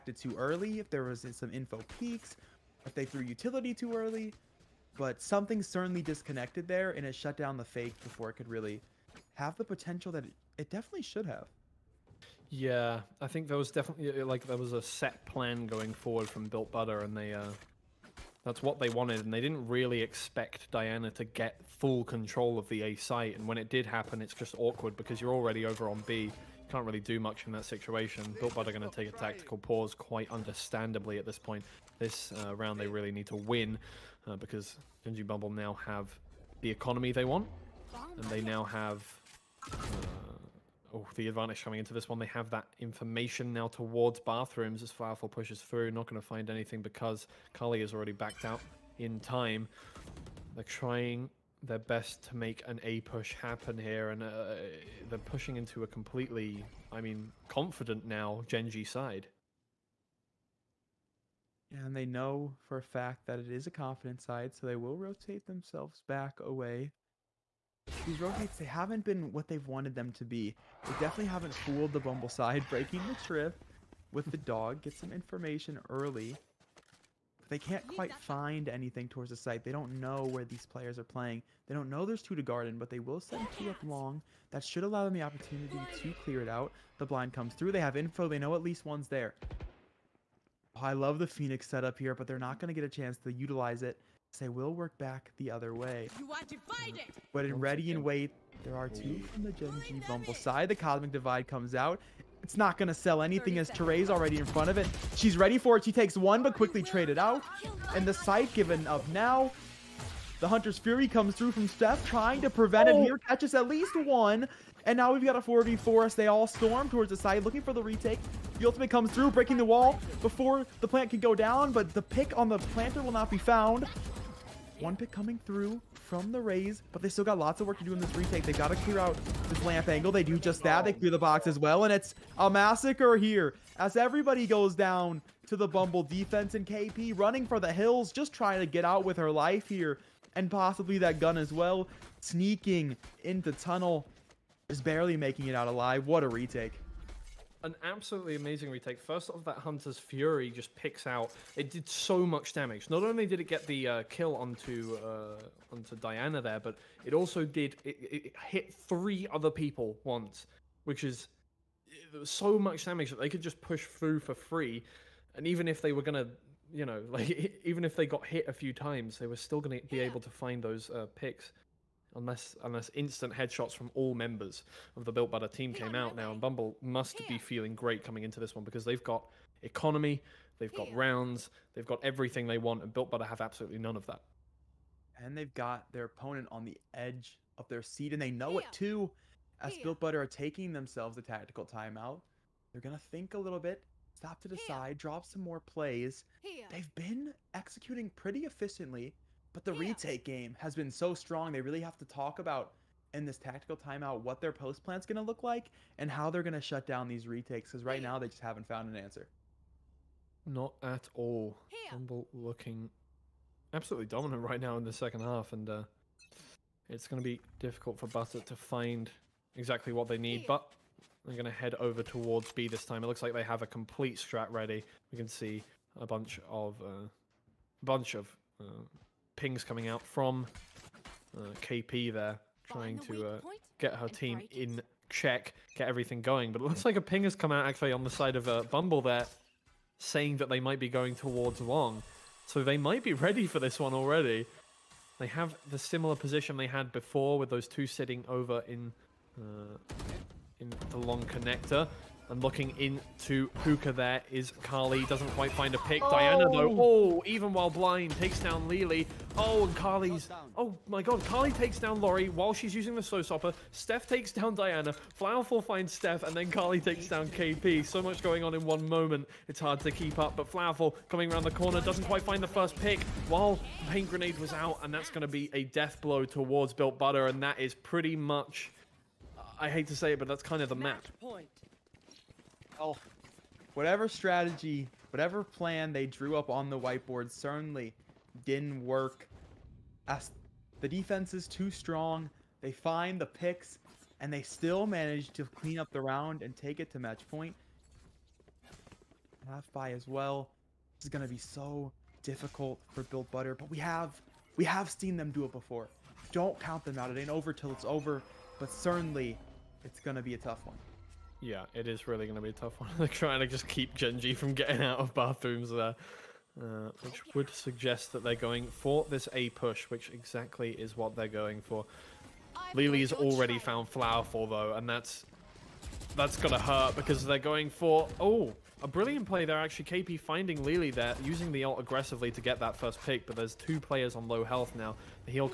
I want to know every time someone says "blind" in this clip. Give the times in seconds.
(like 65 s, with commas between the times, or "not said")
87 s, 257 s.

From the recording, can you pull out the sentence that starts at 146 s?
What a retake an absolutely amazing retake.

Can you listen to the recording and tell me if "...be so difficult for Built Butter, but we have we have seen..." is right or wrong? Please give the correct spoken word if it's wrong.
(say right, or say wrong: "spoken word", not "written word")
right.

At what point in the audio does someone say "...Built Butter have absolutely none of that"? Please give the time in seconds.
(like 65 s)
182 s.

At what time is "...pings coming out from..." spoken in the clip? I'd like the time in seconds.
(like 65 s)
229 s.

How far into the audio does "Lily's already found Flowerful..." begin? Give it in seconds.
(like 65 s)
322 s.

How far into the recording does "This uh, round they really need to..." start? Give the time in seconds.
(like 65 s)
31 s.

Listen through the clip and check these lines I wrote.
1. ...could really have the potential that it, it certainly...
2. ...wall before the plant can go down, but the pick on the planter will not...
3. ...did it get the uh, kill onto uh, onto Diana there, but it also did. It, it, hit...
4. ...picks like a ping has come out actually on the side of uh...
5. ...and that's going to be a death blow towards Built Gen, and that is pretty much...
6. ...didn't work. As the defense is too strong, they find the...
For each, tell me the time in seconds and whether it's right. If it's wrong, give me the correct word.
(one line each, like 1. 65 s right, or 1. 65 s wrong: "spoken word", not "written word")
1. 8 s wrong: "definitely", not "certainly"
2. 119 s right
3. 153 s right
4. 236 s wrong: "looks", not "picks"
5. 274 s wrong: "Butter", not "Gen"
6. 288 s right.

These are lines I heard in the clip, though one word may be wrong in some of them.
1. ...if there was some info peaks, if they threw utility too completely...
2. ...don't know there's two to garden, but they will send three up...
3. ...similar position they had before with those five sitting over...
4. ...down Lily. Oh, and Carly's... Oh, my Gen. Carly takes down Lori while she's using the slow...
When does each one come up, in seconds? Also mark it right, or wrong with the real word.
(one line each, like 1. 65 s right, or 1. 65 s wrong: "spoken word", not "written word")
1. 0 s wrong: "early", not "completely"
2. 81 s wrong: "two", not "three"
3. 245 s wrong: "two", not "five"
4. 258 s wrong: "God", not "Gen".